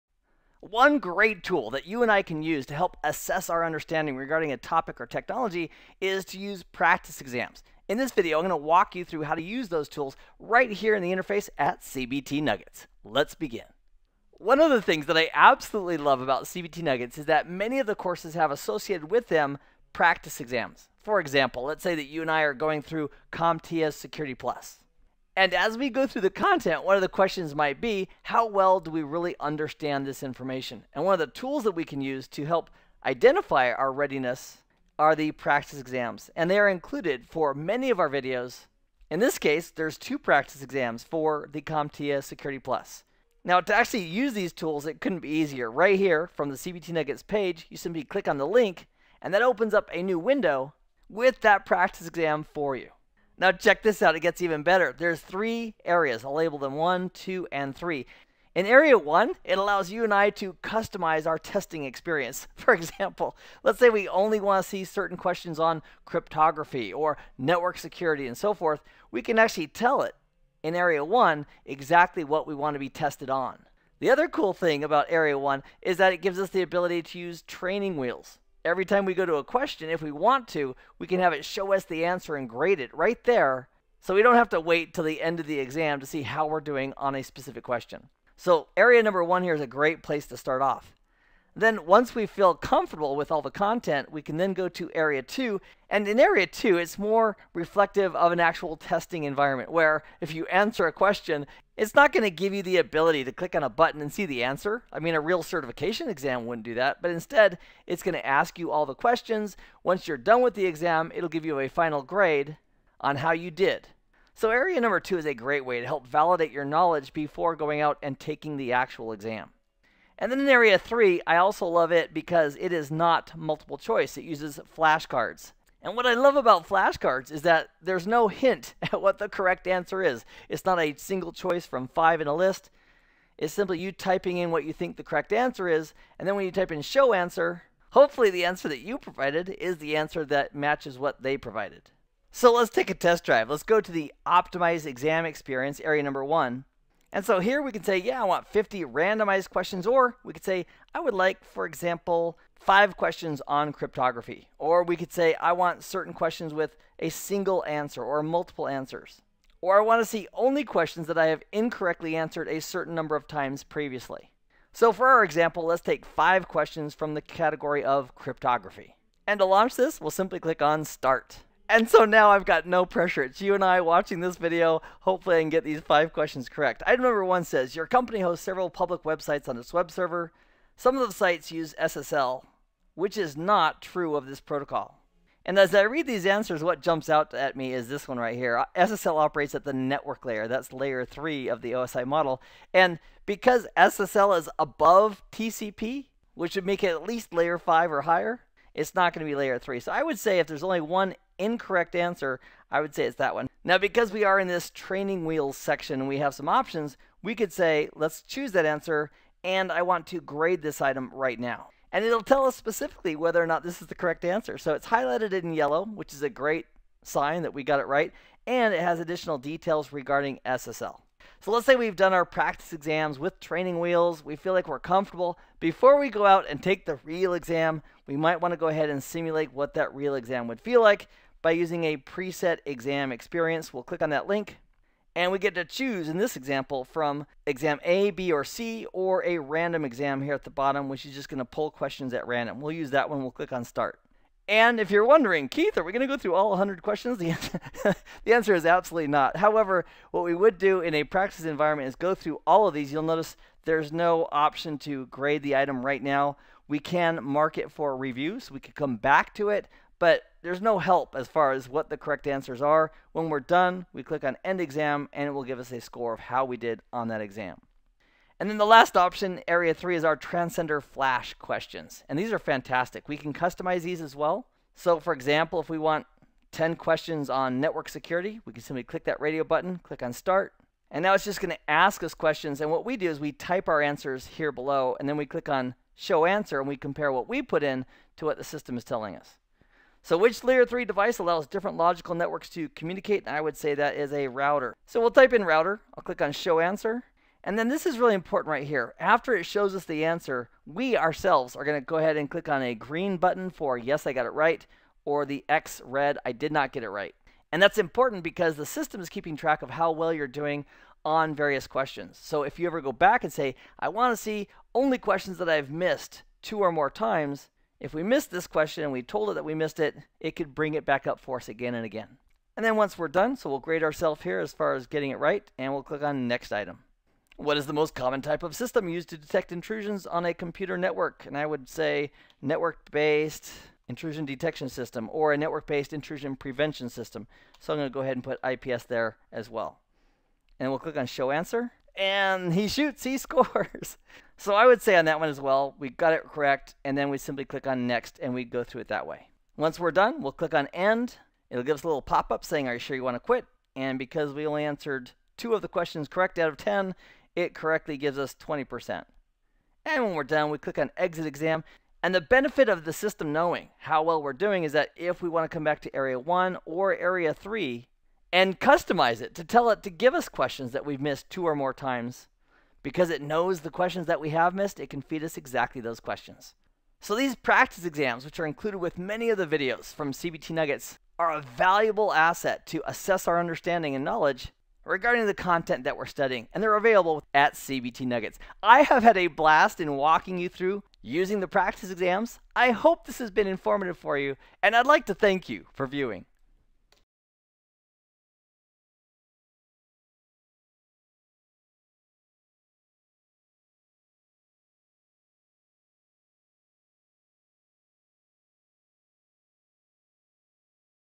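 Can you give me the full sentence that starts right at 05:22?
And then once we're done, so we'll grade ourselves here as far as getting it right, and we'll click on next item.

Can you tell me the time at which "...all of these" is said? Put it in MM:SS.
04:12.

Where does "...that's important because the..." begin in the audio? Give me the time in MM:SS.
05:07.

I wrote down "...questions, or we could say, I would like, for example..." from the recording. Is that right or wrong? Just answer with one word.
right.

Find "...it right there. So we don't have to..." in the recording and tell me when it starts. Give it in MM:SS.
01:22.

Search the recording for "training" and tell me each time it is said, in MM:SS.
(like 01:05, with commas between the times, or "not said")
01:17, 03:24, 03:43.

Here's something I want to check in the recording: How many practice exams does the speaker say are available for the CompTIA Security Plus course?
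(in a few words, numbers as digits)
2.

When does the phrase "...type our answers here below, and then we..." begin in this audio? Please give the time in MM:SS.
04:43.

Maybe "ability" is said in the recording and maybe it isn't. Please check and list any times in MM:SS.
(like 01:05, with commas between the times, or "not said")
01:16, 01:42.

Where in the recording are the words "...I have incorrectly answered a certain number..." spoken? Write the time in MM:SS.
02:41.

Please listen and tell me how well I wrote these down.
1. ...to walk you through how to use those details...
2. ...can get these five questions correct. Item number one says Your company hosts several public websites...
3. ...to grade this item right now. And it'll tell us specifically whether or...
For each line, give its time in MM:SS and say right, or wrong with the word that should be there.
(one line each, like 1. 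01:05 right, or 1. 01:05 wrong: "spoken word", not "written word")
1. 00:08 wrong: "tools", not "details"
2. 02:55 right
3. 03:30 right.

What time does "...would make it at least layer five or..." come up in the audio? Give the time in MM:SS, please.
03:16.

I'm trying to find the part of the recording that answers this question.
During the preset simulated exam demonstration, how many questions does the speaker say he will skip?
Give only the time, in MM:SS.
04:06.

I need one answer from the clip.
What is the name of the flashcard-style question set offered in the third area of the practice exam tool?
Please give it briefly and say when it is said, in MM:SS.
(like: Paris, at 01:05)
Transcender Flash, at 04:30.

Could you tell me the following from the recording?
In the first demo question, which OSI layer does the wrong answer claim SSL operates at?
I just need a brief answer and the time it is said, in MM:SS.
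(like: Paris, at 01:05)
Network layer, at 03:08.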